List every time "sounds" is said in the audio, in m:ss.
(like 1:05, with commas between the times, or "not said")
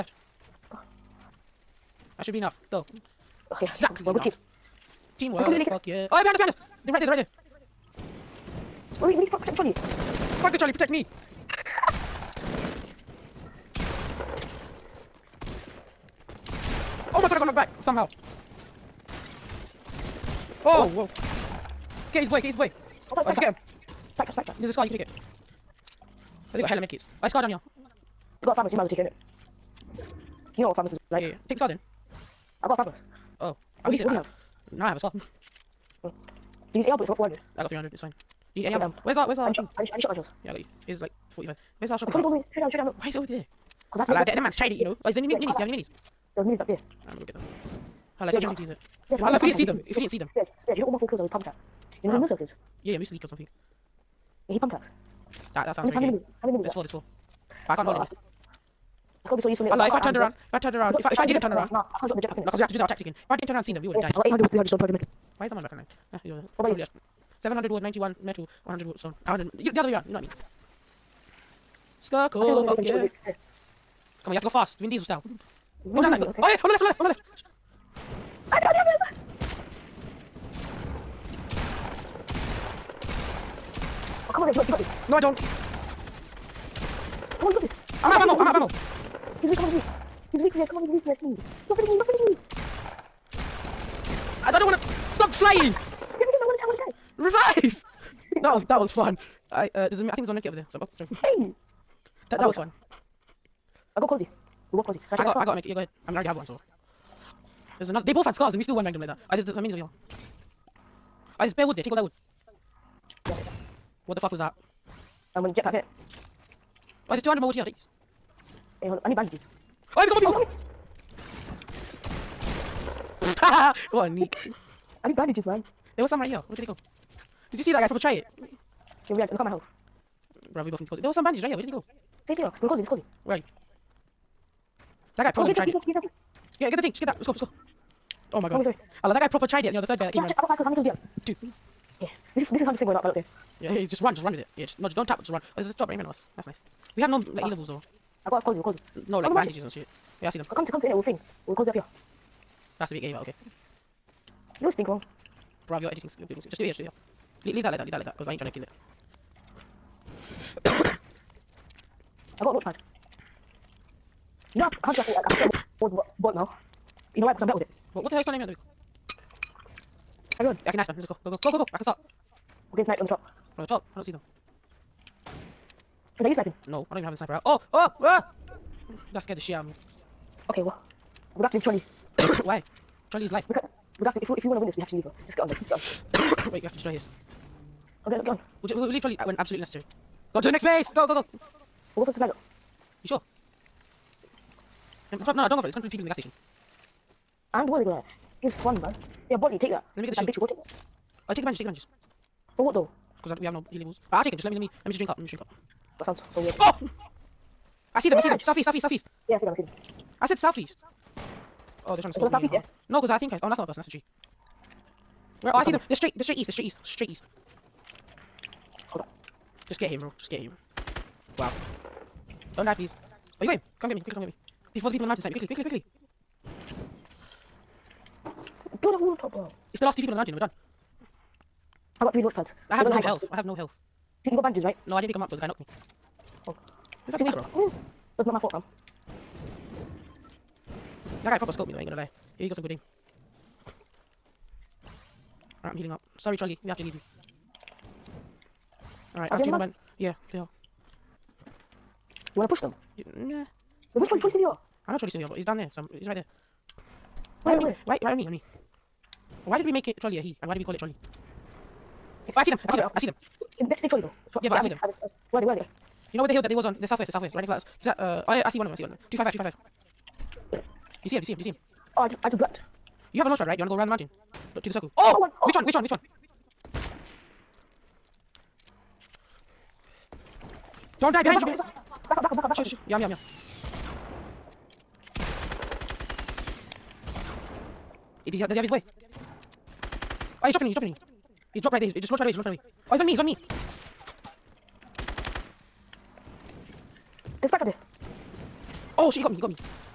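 0:55, 3:26.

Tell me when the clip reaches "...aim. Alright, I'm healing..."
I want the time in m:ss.
4:02.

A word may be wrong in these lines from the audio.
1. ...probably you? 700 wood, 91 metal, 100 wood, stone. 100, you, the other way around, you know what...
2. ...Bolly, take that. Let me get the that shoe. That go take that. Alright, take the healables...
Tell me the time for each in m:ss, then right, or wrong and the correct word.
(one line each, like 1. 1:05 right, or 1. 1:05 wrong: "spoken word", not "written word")
1. 1:06 right
2. 3:19 wrong: "bandages", not "healables".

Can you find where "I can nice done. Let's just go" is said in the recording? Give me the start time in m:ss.
2:50.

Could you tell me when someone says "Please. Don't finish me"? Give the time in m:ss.
1:31.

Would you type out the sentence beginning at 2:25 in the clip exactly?
Oh, there's a drop right in front of us.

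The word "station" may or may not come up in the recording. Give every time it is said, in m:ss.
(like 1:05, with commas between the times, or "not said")
3:16.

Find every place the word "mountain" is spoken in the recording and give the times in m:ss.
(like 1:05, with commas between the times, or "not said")
3:45, 3:50, 4:33.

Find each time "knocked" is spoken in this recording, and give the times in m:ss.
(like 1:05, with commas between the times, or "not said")
0:17, 3:55.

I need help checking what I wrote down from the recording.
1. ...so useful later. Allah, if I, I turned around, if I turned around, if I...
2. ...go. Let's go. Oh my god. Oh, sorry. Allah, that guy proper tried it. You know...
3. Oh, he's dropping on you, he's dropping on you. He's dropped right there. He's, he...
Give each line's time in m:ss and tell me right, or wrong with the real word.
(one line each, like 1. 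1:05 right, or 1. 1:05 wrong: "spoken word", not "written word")
1. 0:59 right
2. 2:17 right
3. 4:50 right.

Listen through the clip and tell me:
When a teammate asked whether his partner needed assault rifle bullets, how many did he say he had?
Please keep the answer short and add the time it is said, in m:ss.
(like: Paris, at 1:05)
400, at 0:37.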